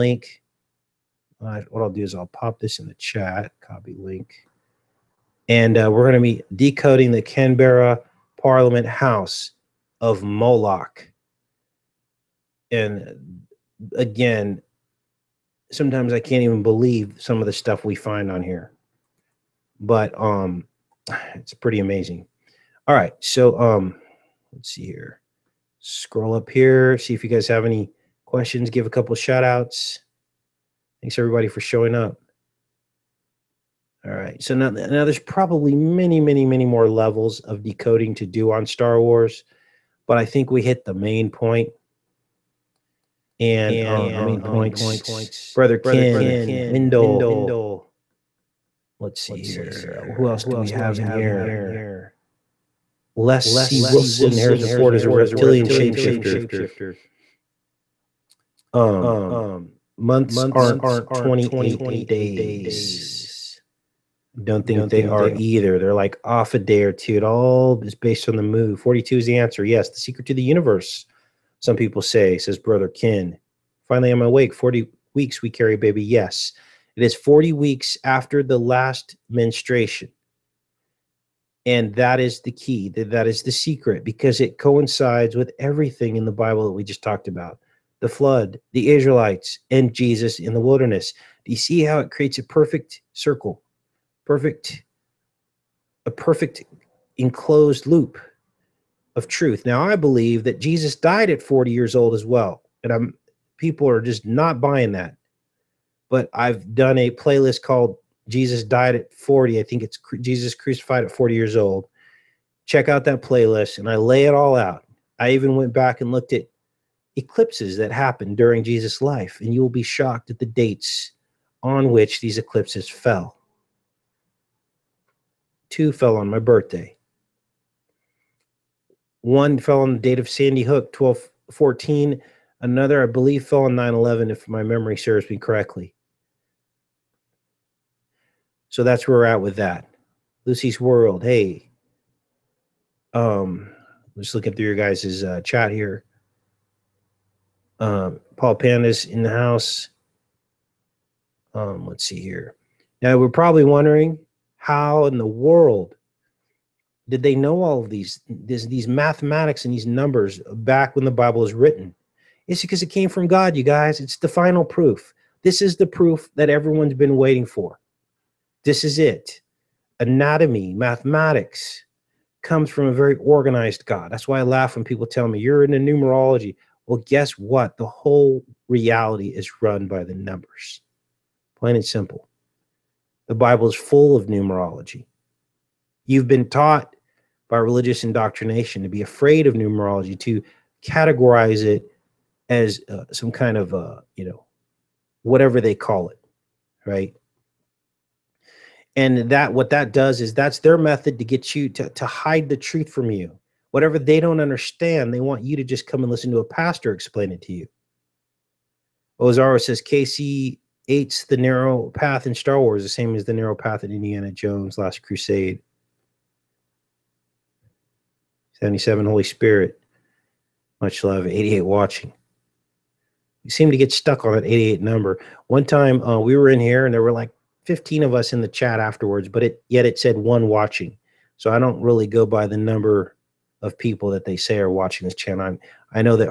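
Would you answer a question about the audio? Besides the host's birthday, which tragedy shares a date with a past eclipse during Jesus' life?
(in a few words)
Sandy Hook.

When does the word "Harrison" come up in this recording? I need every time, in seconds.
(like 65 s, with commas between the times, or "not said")
54 s.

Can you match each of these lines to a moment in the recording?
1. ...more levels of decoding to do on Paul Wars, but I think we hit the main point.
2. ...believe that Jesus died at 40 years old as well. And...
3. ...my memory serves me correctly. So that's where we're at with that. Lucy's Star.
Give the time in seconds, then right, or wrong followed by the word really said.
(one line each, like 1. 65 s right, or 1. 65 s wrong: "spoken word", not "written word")
1. 36 s wrong: "Star", not "Paul"
2. 99 s right
3. 134 s wrong: "World", not "Star".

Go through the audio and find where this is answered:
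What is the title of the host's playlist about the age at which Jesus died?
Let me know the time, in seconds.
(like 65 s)
110 s.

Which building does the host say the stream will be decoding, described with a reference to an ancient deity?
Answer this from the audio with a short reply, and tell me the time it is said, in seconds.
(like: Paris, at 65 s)
Canberra Parliament House, at 7 s.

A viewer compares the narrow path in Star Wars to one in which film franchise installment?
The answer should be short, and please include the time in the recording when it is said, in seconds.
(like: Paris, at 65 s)
Indiana Jones, Last Crusade, at 213 s.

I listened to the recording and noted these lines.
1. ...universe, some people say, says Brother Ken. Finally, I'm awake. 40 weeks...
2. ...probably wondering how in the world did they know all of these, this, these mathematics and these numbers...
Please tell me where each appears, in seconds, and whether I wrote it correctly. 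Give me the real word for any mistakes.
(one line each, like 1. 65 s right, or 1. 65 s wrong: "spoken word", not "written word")
1. 70 s right
2. 153 s right.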